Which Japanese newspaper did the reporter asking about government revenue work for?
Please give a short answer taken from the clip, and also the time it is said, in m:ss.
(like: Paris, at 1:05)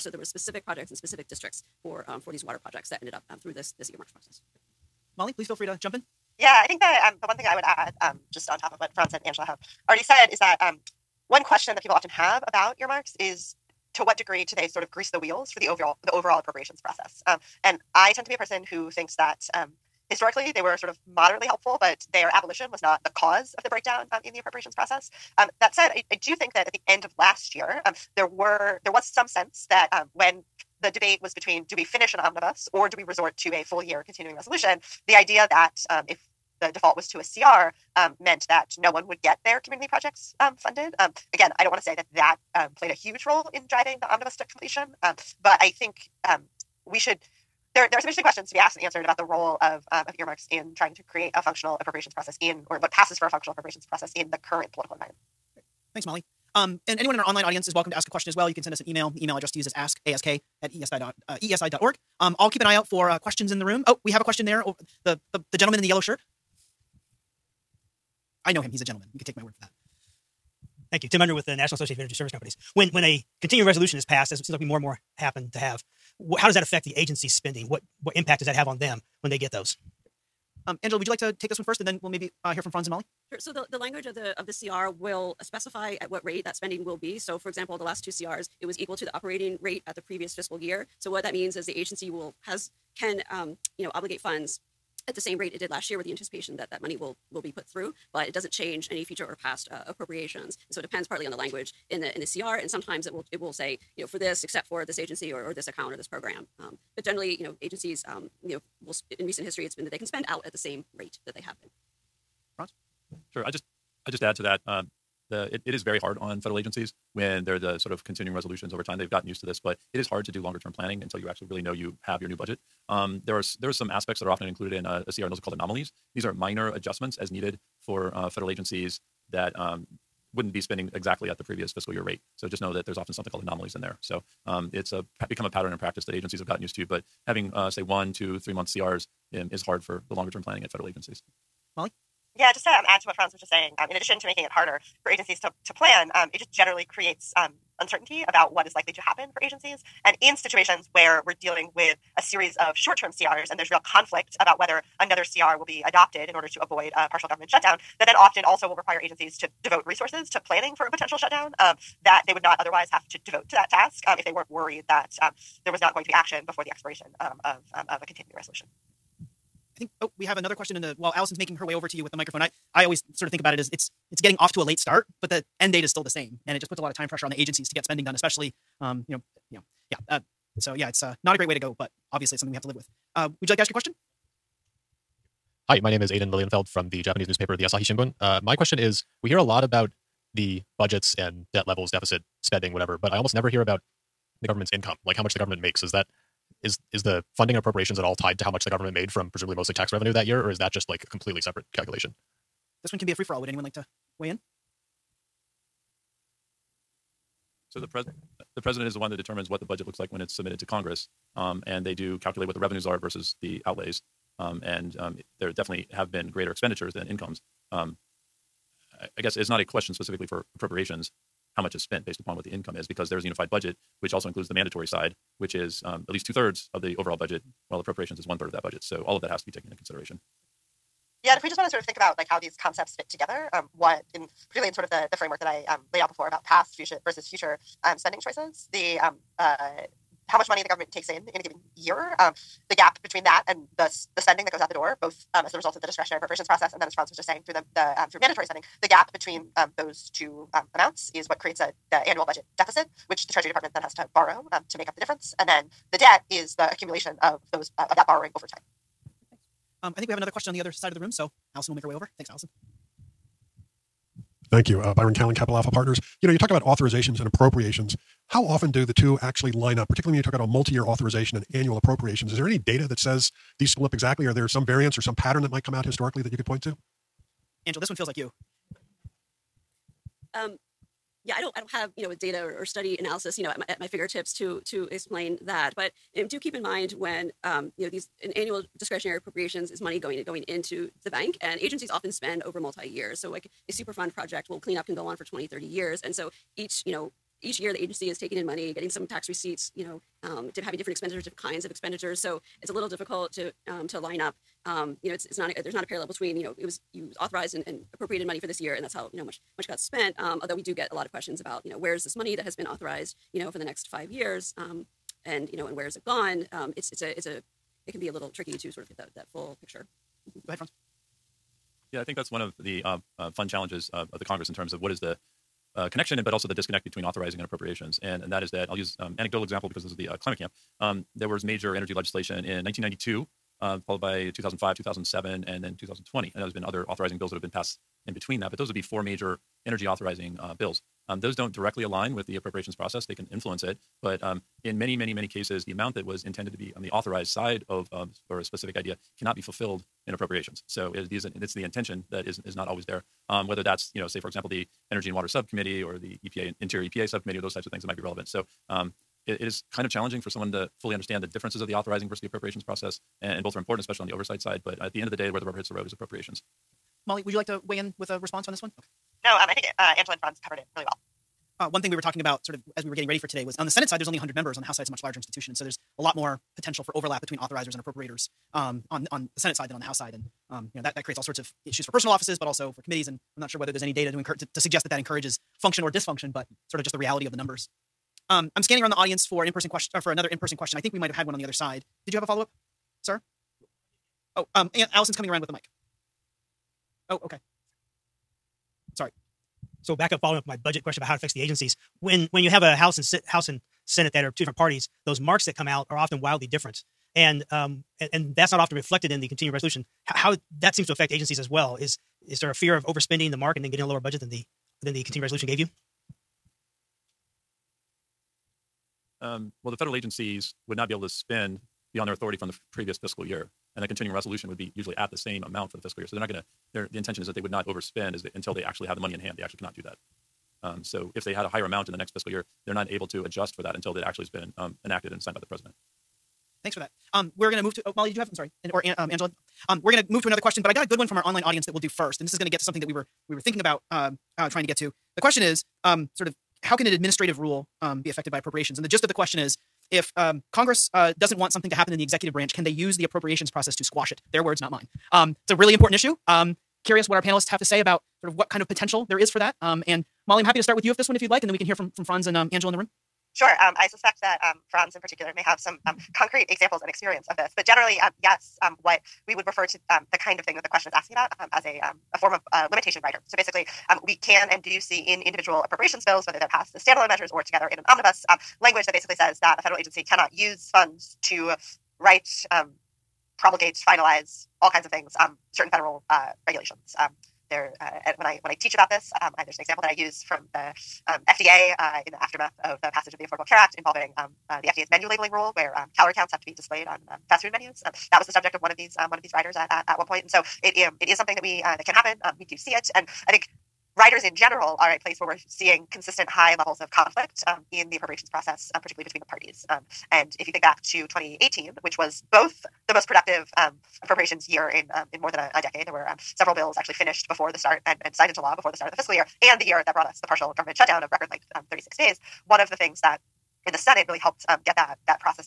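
The Asahi Shimbun, at 3:07.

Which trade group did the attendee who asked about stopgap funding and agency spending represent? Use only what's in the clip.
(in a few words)
National Association of Energy Service Companies.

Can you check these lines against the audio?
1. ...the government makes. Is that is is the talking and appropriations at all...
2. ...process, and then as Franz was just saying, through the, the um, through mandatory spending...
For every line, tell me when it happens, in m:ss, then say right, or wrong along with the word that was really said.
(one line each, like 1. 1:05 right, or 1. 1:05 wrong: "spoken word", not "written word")
1. 3:15 wrong: "funding", not "talking"
2. 4:06 right.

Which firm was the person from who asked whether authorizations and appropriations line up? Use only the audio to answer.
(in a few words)
Capital Alpha Partners.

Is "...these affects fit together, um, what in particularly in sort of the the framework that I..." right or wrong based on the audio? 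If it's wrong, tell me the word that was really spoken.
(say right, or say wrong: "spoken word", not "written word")
wrong: "concepts", not "affects".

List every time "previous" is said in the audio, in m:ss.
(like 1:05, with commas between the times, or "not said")
1:30, 2:11, 7:02.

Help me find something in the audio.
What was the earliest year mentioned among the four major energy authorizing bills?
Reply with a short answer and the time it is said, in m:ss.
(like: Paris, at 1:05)
1992, at 5:32.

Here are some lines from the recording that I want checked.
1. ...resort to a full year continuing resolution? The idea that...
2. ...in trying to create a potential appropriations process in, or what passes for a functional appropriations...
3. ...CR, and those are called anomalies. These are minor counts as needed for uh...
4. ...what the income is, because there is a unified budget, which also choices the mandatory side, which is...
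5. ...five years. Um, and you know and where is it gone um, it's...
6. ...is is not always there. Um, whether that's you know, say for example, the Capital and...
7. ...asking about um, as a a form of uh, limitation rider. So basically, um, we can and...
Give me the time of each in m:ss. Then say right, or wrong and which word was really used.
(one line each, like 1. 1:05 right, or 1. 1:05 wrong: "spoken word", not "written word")
1. 0:33 right
2. 0:50 wrong: "functional", not "potential"
3. 2:05 wrong: "adjustments", not "counts"
4. 3:42 wrong: "includes", not "choices"
5. 5:13 right
6. 5:52 wrong: "Energy", not "Capital"
7. 7:50 right.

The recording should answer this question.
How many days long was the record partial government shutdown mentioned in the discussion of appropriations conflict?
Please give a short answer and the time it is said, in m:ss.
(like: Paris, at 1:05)
36, at 8:41.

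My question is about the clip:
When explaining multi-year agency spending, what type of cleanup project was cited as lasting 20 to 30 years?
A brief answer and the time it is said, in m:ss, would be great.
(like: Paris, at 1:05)
Superfund, at 4:53.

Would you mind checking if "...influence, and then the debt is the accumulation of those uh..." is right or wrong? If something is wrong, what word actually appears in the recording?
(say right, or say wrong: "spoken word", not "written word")
wrong: "difference", not "influence".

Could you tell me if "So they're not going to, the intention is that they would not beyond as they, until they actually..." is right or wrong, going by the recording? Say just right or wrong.
wrong.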